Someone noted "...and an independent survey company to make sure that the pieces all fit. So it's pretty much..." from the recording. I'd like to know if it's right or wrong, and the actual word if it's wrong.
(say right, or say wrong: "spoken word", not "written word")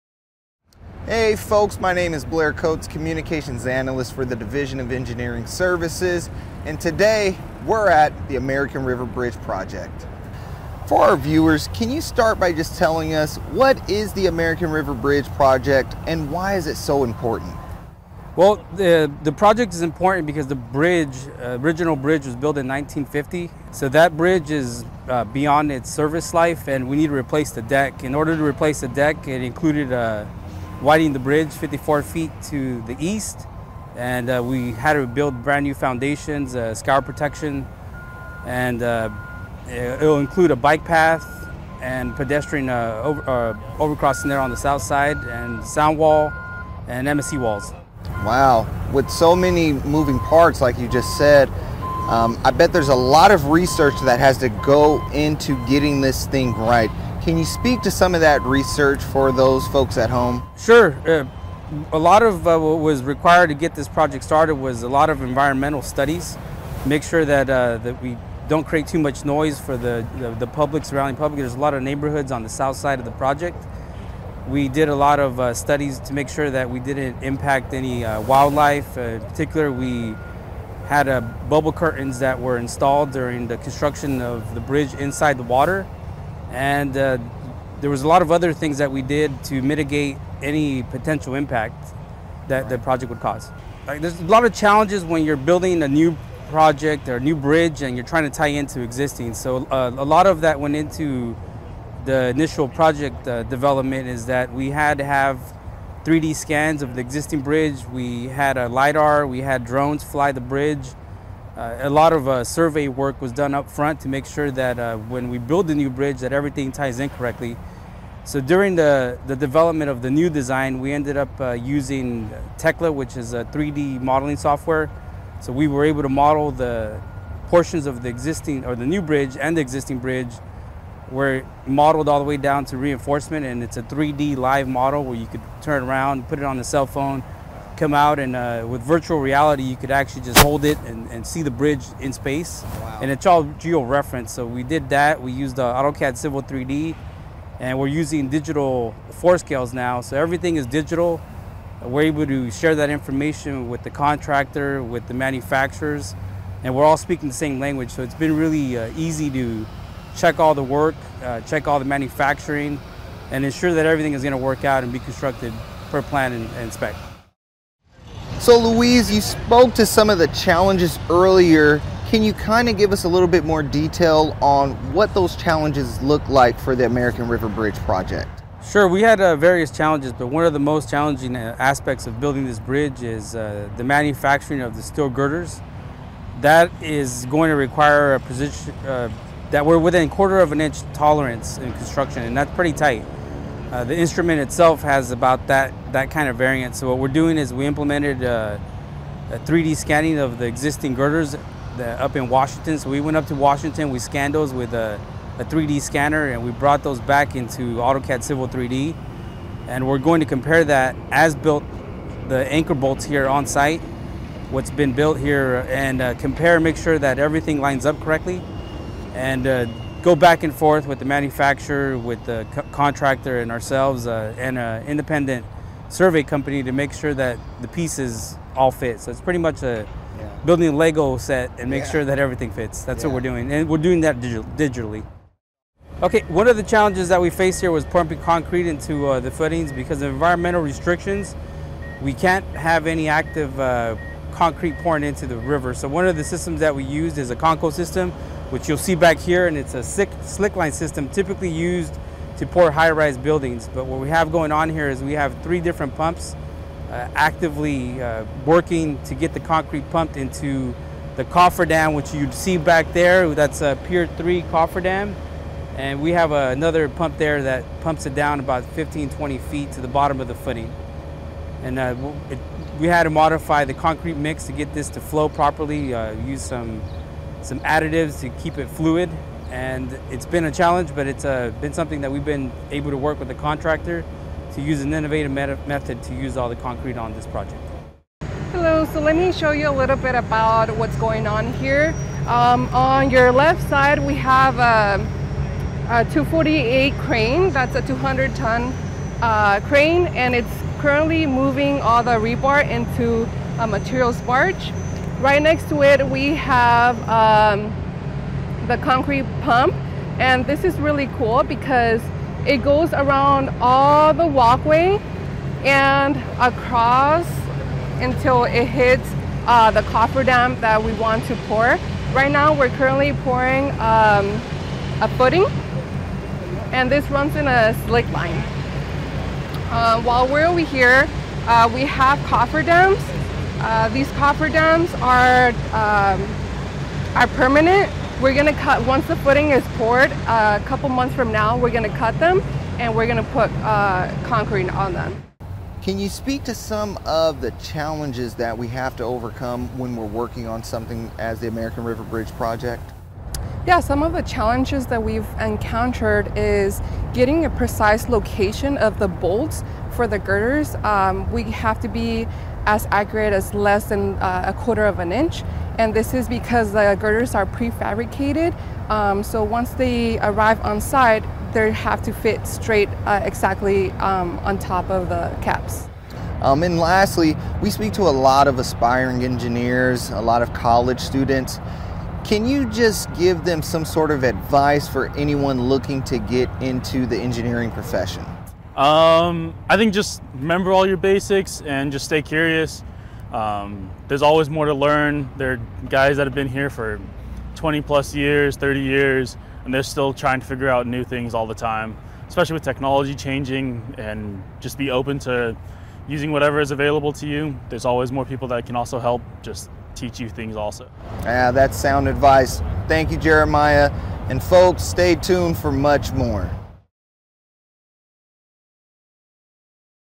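right.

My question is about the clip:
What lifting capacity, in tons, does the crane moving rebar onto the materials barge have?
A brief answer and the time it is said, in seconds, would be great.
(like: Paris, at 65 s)
200 tons, at 297 s.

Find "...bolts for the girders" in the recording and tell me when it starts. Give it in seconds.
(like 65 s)
359 s.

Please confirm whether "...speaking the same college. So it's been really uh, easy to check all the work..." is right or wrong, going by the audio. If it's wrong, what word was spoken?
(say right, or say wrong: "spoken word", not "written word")
wrong: "language", not "college".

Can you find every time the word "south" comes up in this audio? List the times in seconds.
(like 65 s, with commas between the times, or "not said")
44 s, 72 s.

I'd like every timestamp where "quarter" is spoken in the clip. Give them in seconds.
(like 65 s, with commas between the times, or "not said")
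190 s, 364 s.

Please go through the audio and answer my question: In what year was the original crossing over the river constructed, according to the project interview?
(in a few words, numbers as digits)
1950.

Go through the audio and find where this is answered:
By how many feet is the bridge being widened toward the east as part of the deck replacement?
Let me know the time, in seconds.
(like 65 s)
31 s.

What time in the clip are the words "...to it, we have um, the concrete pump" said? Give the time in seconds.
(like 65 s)
305 s.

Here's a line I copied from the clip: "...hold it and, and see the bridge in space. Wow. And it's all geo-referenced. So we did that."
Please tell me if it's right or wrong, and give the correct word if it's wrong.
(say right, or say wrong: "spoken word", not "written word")
right.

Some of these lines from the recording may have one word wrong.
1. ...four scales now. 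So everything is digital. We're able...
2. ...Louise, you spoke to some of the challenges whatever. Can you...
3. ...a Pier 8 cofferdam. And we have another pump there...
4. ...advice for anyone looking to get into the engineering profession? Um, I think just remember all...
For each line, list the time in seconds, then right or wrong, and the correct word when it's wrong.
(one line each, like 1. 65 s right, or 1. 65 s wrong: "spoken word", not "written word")
1. 149 s right
2. 168 s wrong: "earlier", not "whatever"
3. 263 s wrong: "3", not "8"
4. 384 s right.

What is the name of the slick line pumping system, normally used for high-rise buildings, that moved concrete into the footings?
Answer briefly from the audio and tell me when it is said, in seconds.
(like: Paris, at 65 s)
Conco, at 247 s.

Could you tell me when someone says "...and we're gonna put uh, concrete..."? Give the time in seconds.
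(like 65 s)
342 s.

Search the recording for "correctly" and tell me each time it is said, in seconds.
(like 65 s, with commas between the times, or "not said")
117 s, 218 s.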